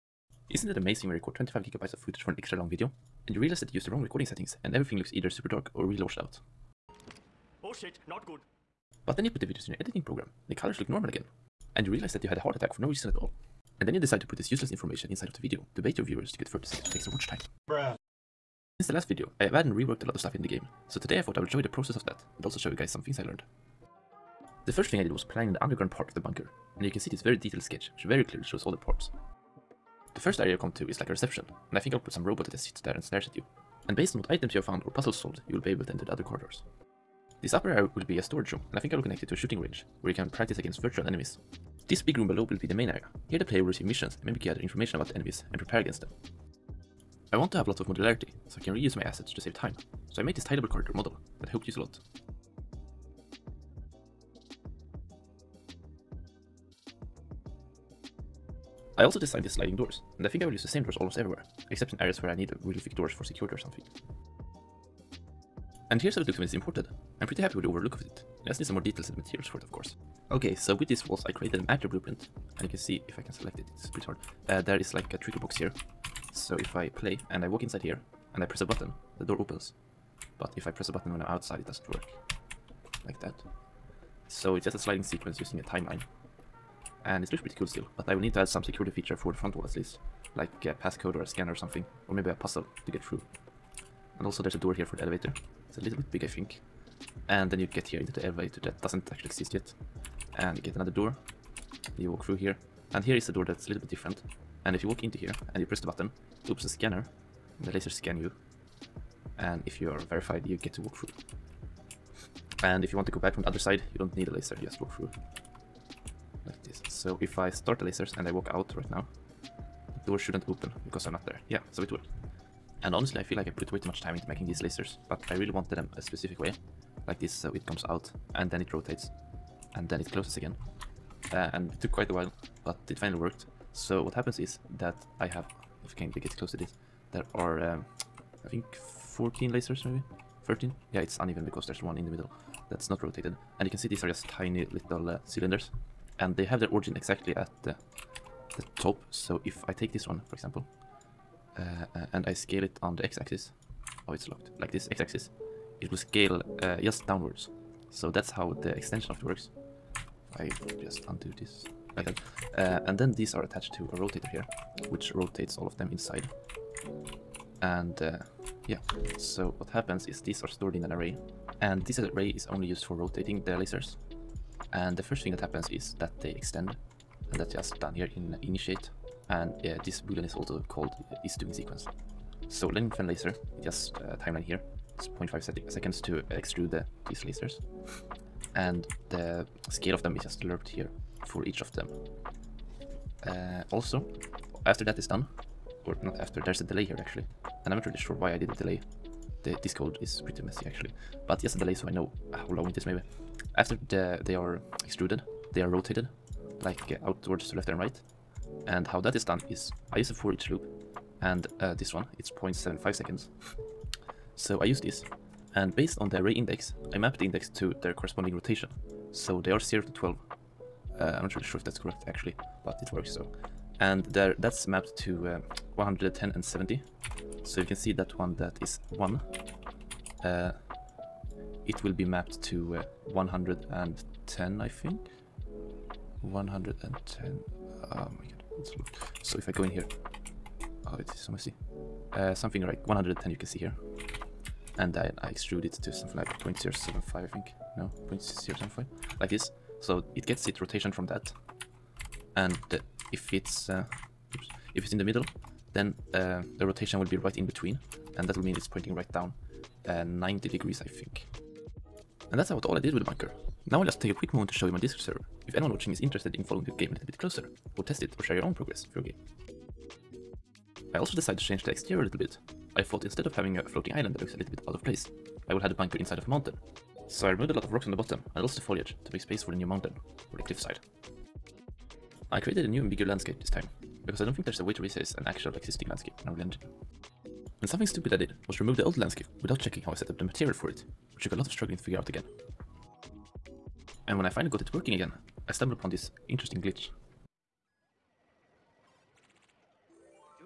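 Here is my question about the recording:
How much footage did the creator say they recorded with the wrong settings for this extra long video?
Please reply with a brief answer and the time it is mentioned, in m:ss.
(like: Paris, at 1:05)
25 gigabytes, at 0:01.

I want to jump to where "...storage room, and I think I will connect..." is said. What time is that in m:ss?
0:38.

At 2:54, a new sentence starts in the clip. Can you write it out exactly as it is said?
And the first thing that happens is that they extend.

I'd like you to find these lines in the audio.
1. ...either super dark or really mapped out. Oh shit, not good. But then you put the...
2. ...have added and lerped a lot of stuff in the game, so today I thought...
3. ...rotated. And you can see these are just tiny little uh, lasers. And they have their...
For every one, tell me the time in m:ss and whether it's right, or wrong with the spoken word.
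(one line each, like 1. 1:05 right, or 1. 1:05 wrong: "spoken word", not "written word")
1. 0:05 wrong: "washed", not "mapped"
2. 0:19 wrong: "reworked", not "lerped"
3. 2:23 wrong: "cylinders", not "lasers".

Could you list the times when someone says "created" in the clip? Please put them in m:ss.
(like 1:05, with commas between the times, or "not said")
1:11, 4:42.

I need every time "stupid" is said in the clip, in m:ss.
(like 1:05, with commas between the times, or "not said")
4:47.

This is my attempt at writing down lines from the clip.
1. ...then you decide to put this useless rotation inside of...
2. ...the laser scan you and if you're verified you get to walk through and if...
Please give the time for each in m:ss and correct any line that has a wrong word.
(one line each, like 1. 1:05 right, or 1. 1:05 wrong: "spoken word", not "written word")
1. 0:13 wrong: "information", not "rotation"
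2. 1:47 right.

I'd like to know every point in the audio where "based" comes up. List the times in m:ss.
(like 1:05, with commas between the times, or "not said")
0:33, 3:35.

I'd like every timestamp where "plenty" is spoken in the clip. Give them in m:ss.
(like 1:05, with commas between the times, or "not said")
not said.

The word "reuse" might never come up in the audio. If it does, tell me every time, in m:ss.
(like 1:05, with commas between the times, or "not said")
0:48.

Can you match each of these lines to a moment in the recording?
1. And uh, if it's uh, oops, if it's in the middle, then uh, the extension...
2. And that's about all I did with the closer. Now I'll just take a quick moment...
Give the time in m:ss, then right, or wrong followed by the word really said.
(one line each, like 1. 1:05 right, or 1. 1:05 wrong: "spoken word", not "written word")
1. 4:12 wrong: "rotation", not "extension"
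2. 4:22 wrong: "bunker", not "closer".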